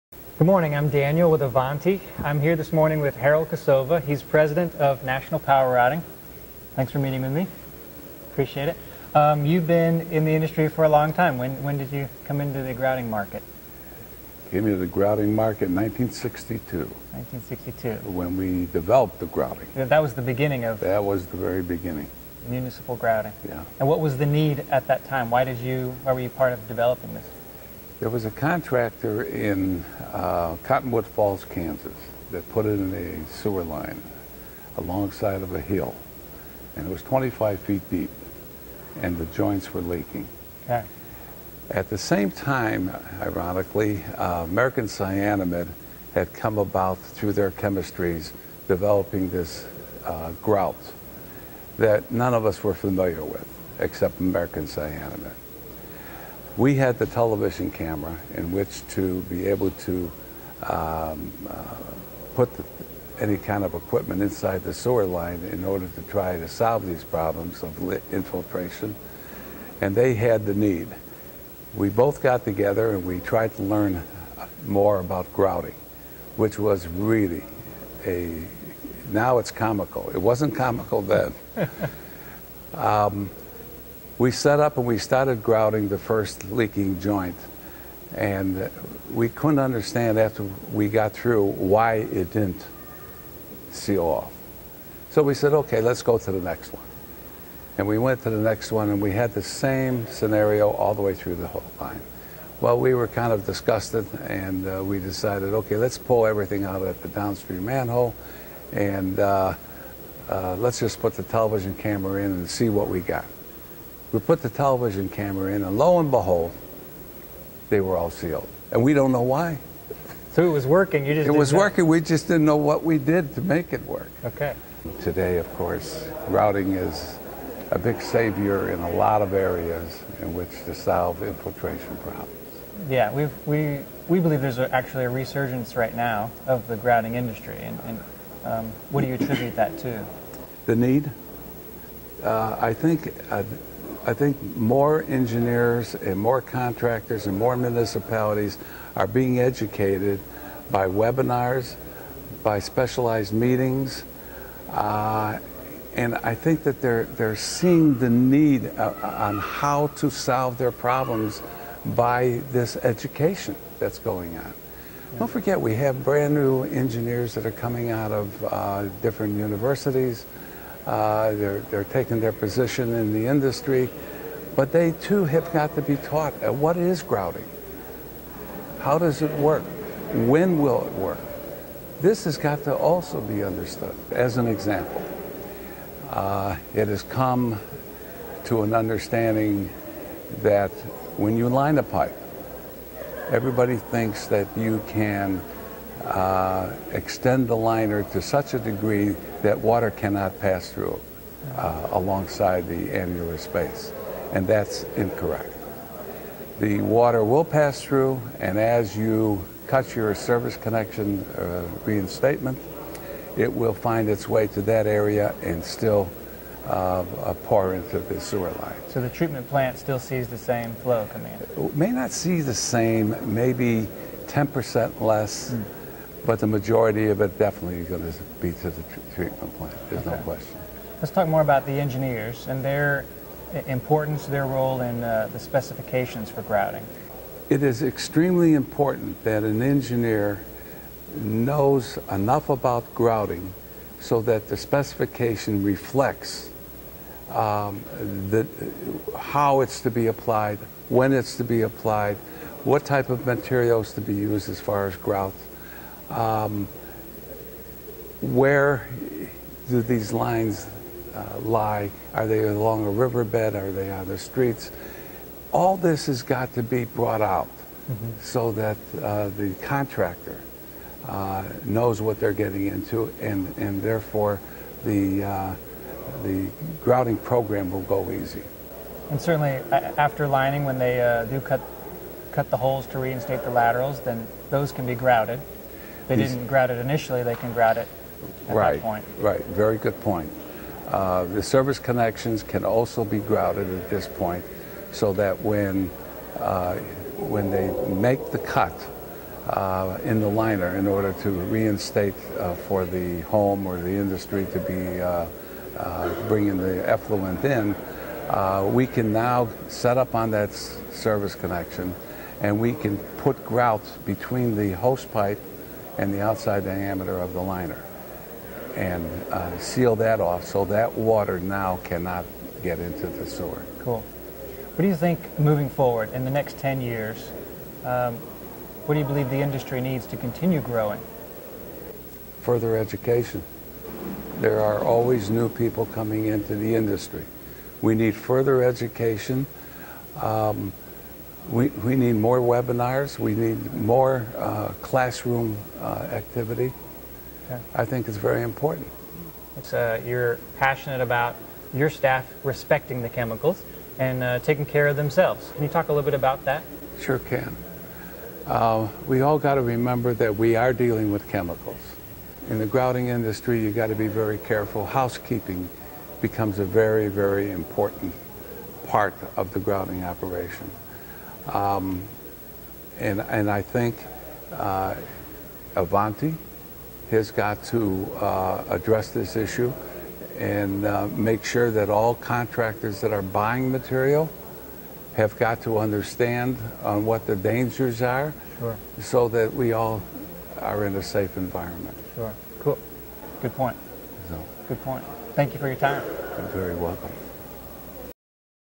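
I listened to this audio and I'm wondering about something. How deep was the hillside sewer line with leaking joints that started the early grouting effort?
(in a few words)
25 feet.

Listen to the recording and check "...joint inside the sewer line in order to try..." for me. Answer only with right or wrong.
wrong.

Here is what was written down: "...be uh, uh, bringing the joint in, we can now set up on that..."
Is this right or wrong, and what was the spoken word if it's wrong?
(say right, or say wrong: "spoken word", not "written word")
wrong: "effluent", not "joint".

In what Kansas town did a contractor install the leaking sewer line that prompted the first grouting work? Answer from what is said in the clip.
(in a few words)
Cottonwood Falls.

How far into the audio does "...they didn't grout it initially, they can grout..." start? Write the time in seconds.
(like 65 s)
286 s.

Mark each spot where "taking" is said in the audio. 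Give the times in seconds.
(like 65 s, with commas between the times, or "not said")
171 s, 354 s.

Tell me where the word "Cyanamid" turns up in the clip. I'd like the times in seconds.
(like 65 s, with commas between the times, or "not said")
44 s, 54 s.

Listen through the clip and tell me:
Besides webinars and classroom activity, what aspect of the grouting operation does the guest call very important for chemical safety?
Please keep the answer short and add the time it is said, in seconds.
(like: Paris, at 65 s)
Housekeeping, at 364 s.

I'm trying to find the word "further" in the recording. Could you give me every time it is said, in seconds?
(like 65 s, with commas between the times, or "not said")
332 s, 338 s.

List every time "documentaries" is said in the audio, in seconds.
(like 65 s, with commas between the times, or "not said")
not said.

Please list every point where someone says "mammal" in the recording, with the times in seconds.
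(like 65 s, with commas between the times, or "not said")
not said.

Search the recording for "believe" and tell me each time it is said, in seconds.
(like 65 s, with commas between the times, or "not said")
134 s, 329 s.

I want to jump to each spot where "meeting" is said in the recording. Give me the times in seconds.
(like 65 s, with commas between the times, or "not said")
6 s, 153 s.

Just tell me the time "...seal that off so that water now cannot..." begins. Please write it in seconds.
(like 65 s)
319 s.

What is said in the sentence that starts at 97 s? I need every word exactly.
And we went to the next one and we had the same scenario all the way through the whole line.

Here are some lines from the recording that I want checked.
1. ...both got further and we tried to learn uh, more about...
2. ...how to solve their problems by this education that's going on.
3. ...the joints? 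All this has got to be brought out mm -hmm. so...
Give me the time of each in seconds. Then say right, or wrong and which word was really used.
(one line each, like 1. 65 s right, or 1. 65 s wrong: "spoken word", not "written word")
1. 71 s wrong: "together", not "further"
2. 159 s right
3. 264 s wrong: "streets", not "joints".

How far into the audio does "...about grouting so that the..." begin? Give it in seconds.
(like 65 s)
242 s.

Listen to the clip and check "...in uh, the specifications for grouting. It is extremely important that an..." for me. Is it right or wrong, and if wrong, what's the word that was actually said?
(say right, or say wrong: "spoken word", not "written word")
right.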